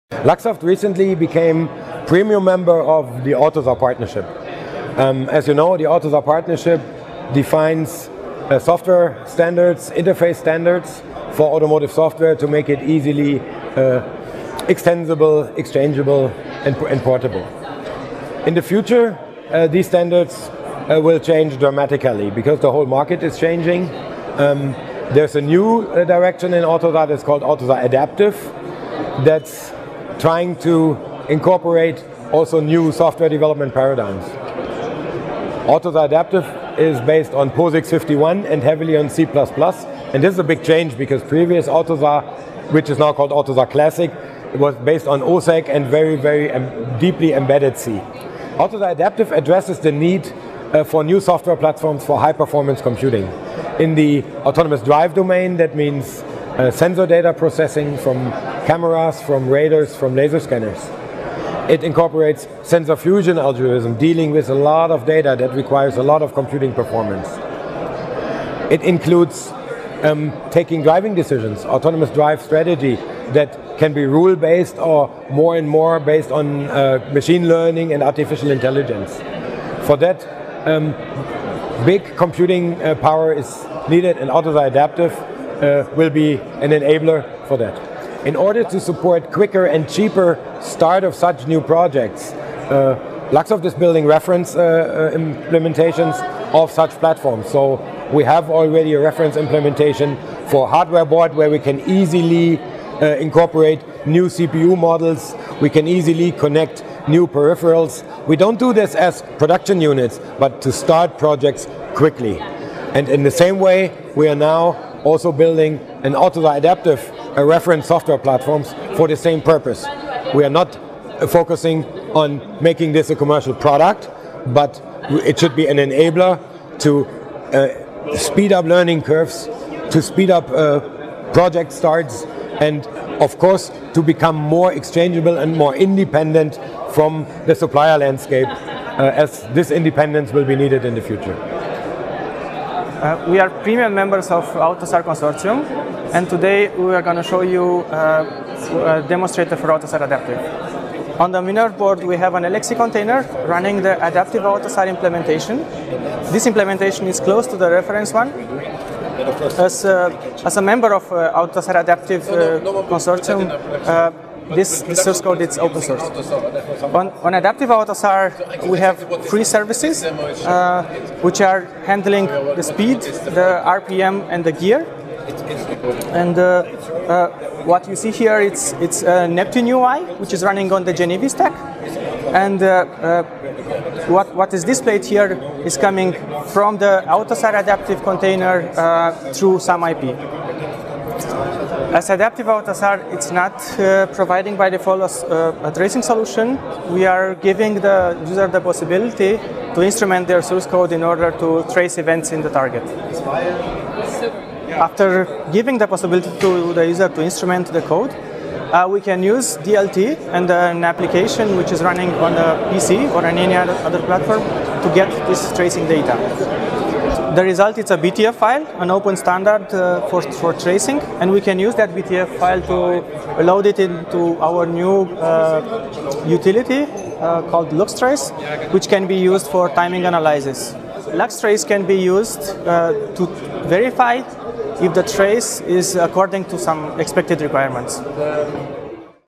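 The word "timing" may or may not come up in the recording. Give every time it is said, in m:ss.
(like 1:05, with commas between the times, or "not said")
3:49.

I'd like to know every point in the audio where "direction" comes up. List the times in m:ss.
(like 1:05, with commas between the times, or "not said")
0:26.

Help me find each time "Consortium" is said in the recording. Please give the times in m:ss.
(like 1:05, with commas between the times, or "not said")
2:25, 2:42.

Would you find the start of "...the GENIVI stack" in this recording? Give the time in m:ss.
3:00.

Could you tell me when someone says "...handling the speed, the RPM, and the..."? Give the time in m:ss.
2:51.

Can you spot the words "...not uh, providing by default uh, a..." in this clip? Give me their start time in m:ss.
3:13.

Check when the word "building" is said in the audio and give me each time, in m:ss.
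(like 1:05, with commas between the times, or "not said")
1:33, 1:55.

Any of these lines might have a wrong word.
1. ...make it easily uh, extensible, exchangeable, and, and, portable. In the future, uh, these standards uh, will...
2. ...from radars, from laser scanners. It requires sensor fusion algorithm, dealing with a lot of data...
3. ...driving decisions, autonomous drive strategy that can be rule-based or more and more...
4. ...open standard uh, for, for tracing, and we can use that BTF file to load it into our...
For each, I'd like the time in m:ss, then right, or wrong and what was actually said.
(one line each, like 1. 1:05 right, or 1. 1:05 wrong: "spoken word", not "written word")
1. 0:12 right
2. 0:59 wrong: "incorporates", not "requires"
3. 1:10 right
4. 3:38 right.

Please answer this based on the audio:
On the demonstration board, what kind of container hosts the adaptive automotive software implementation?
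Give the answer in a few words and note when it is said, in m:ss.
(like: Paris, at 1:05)
LXC container, at 2:32.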